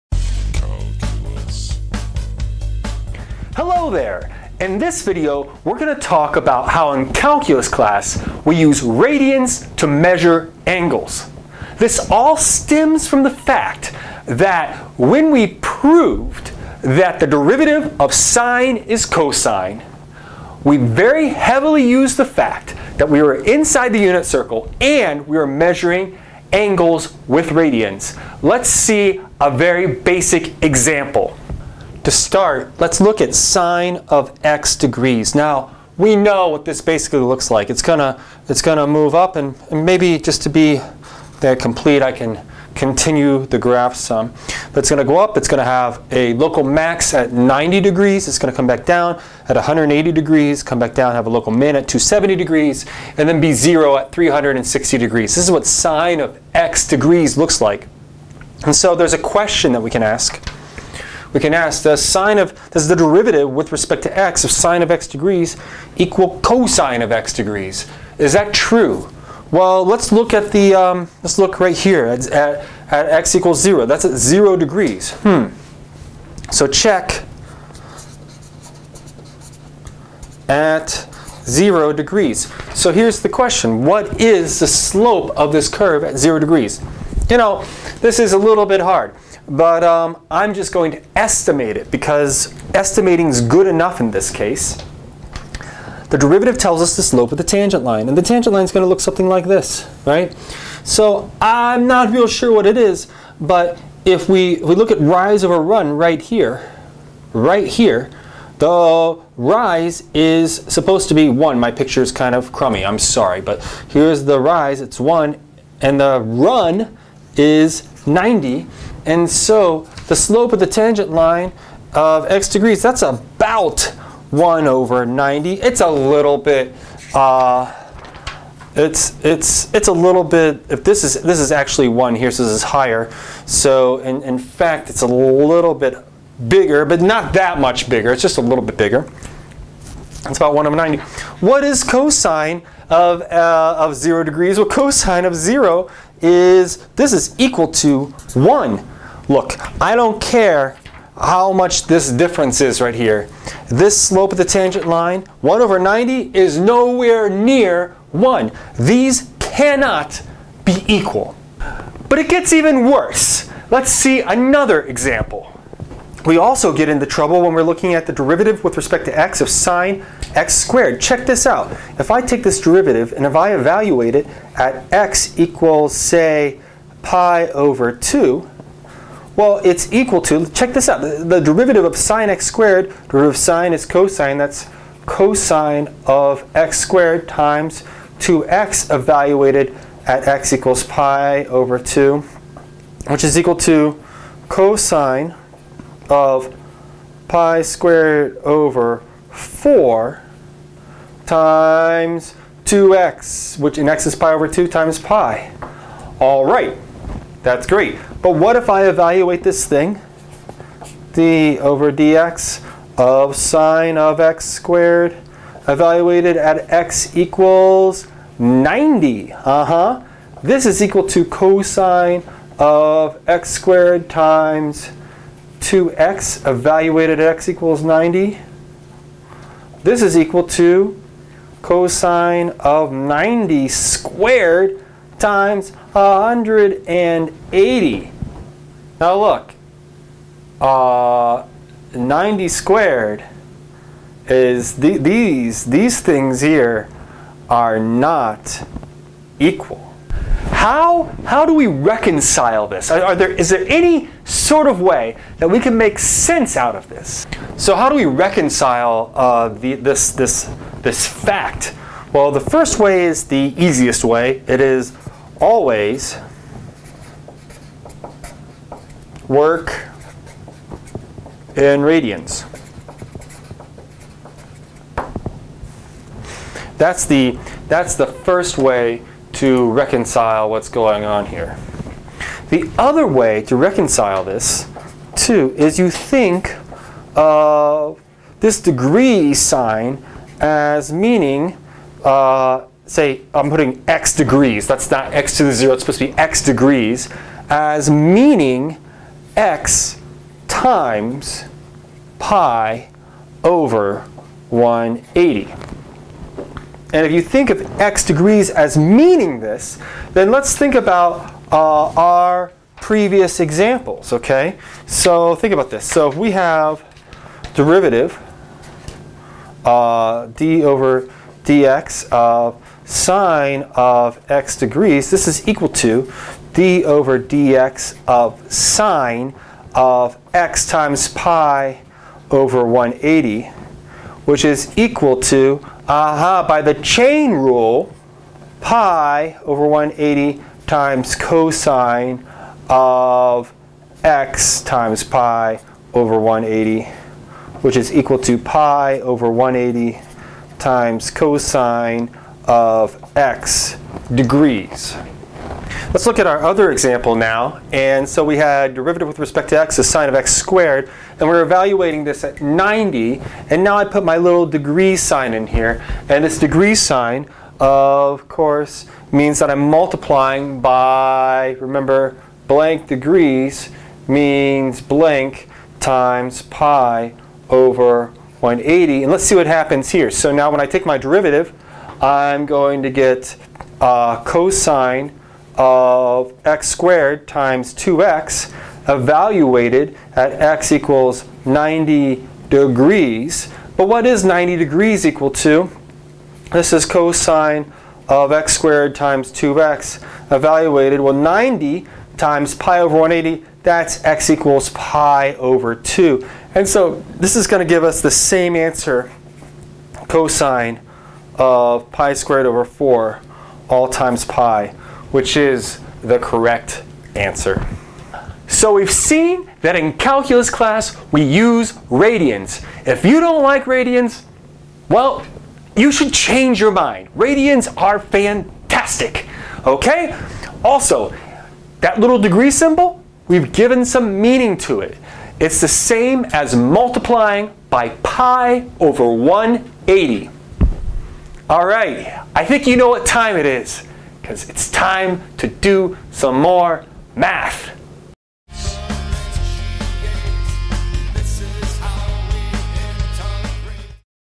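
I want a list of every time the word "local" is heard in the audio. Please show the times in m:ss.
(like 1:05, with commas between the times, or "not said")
0:46, 0:51.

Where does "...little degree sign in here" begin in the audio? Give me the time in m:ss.
6:04.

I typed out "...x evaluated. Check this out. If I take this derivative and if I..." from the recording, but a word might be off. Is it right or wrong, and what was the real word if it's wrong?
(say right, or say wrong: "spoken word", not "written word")
wrong: "squared", not "evaluated".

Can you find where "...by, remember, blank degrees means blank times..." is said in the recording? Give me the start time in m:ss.
6:10.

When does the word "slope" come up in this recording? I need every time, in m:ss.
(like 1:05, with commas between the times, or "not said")
1:24, 1:37, 2:00, 2:33.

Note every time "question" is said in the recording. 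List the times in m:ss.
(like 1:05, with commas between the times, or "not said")
0:59, 1:23.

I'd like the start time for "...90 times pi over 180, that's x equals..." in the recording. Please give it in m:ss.
6:41.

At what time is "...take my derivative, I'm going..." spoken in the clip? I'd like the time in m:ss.
6:20.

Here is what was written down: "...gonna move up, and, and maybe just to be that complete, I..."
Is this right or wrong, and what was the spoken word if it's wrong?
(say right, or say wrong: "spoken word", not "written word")
right.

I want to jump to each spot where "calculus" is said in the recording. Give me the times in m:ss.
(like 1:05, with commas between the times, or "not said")
0:07, 6:59.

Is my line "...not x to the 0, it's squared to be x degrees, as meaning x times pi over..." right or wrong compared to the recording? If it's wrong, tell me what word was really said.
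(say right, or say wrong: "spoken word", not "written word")
wrong: "supposed", not "squared".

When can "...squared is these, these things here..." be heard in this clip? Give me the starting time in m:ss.
4:02.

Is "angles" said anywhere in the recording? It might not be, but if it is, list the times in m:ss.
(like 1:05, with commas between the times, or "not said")
0:10, 0:26.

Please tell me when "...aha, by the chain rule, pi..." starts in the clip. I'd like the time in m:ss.
5:35.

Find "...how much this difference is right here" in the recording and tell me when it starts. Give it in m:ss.
2:31.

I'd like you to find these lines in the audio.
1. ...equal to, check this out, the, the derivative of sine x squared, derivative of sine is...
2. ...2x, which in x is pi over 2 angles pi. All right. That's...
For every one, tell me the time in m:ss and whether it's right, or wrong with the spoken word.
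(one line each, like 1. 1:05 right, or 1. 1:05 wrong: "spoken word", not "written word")
1. 2:59 right
2. 3:22 wrong: "times", not "angles".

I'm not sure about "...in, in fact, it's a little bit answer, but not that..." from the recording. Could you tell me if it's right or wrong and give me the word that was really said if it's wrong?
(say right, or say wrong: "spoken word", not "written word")
wrong: "bigger", not "answer".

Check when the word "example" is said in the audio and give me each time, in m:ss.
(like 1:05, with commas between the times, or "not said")
0:30, 2:44, 5:13, 5:56.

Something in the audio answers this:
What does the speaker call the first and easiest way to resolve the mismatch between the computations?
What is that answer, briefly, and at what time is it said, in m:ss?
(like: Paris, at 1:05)
Always work in radians, at 4:25.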